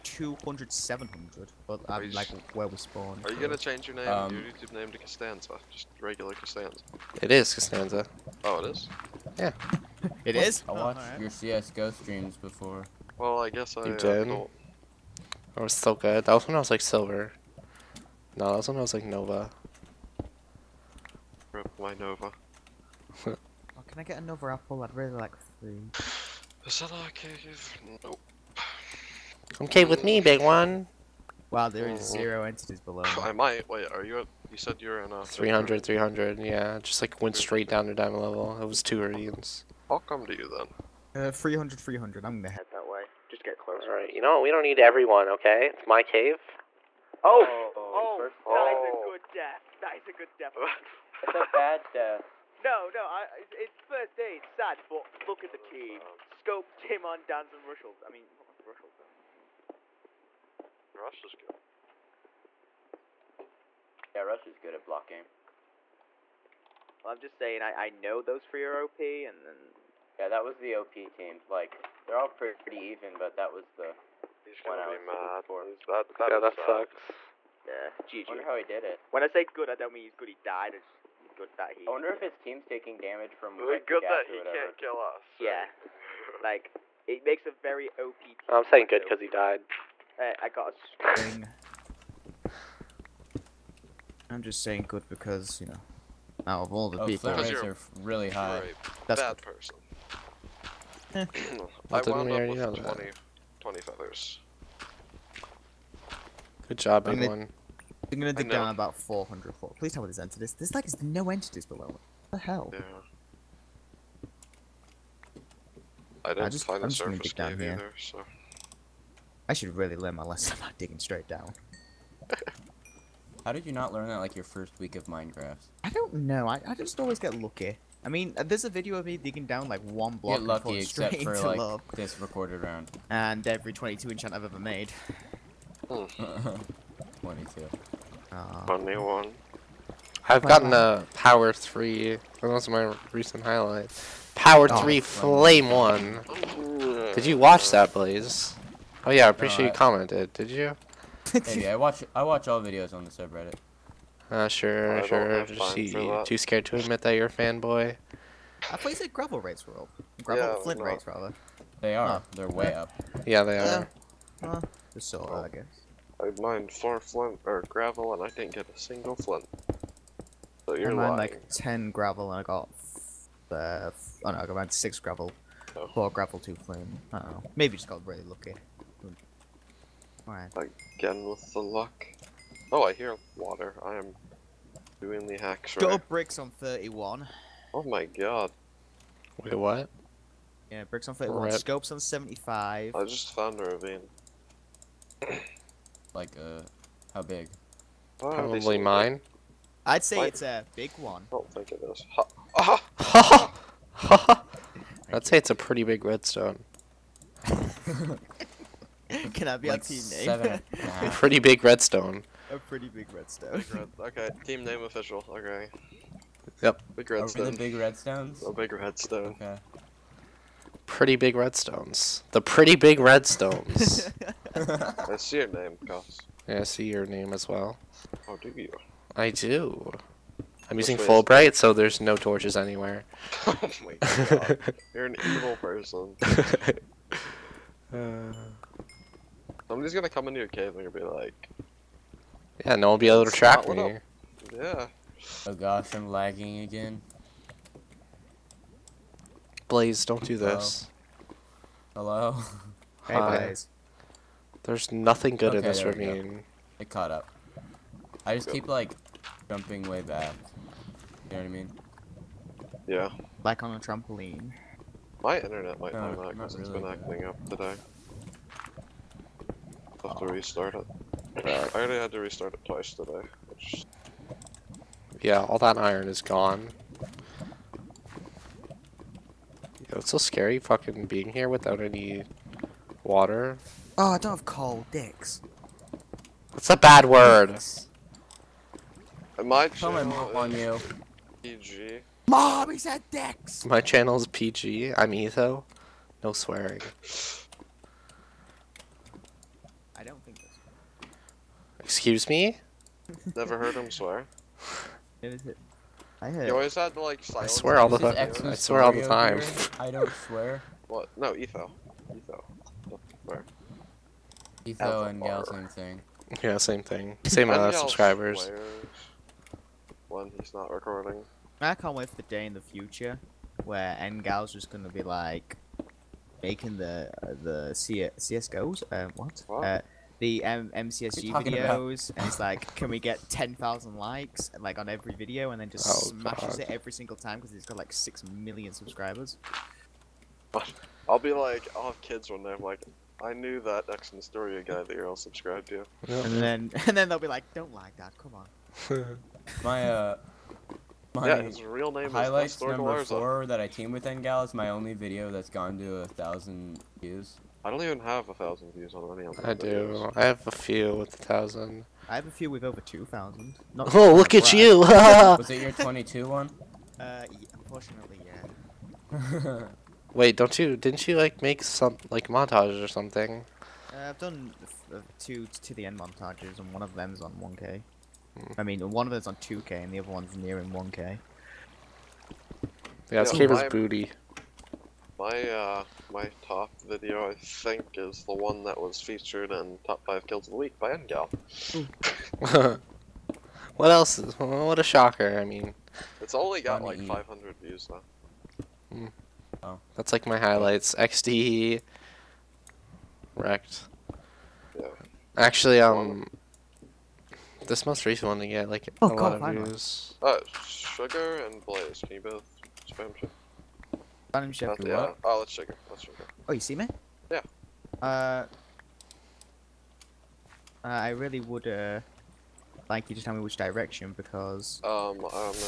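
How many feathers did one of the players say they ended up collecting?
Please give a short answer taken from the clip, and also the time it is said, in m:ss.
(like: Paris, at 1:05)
20, at 1:43.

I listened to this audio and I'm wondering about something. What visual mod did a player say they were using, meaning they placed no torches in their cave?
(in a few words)
Fullbright.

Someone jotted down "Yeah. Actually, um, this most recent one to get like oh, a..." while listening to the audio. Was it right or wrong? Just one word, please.
right.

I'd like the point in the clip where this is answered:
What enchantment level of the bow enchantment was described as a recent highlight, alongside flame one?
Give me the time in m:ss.
2:21.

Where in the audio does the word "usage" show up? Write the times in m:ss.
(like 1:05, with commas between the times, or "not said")
not said.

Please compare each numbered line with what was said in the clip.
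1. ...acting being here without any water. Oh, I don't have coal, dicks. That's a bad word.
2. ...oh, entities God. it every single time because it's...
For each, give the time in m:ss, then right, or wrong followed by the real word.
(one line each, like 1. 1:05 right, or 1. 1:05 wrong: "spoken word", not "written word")
1. 4:40 wrong: "fucking", not "acting"
2. 5:35 wrong: "smashes", not "entities".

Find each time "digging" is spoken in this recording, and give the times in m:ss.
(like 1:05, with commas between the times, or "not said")
2:00, 2:09.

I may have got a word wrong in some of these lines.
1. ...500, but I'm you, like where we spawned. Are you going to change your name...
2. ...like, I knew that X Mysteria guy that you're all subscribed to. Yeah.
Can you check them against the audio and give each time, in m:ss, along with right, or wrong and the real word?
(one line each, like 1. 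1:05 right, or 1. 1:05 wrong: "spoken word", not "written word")
1. 0:00 wrong: "700", not "500"
2. 5:42 right.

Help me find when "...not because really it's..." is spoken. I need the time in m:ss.
4:26.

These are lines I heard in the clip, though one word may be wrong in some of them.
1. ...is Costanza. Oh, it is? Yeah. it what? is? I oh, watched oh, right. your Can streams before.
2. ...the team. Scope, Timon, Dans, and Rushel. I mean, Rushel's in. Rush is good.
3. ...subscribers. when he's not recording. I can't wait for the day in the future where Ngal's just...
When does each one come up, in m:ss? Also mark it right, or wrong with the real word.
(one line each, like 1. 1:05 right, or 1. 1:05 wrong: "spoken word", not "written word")
1. 0:07 wrong: "CSGO", not "Can"
2. 0:55 right
3. 5:17 right.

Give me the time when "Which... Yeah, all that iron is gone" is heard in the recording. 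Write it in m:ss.
4:33.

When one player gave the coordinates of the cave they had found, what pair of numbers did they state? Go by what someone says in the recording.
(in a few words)
300, 300.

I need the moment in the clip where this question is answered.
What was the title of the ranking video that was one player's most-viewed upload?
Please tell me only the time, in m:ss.
6:29.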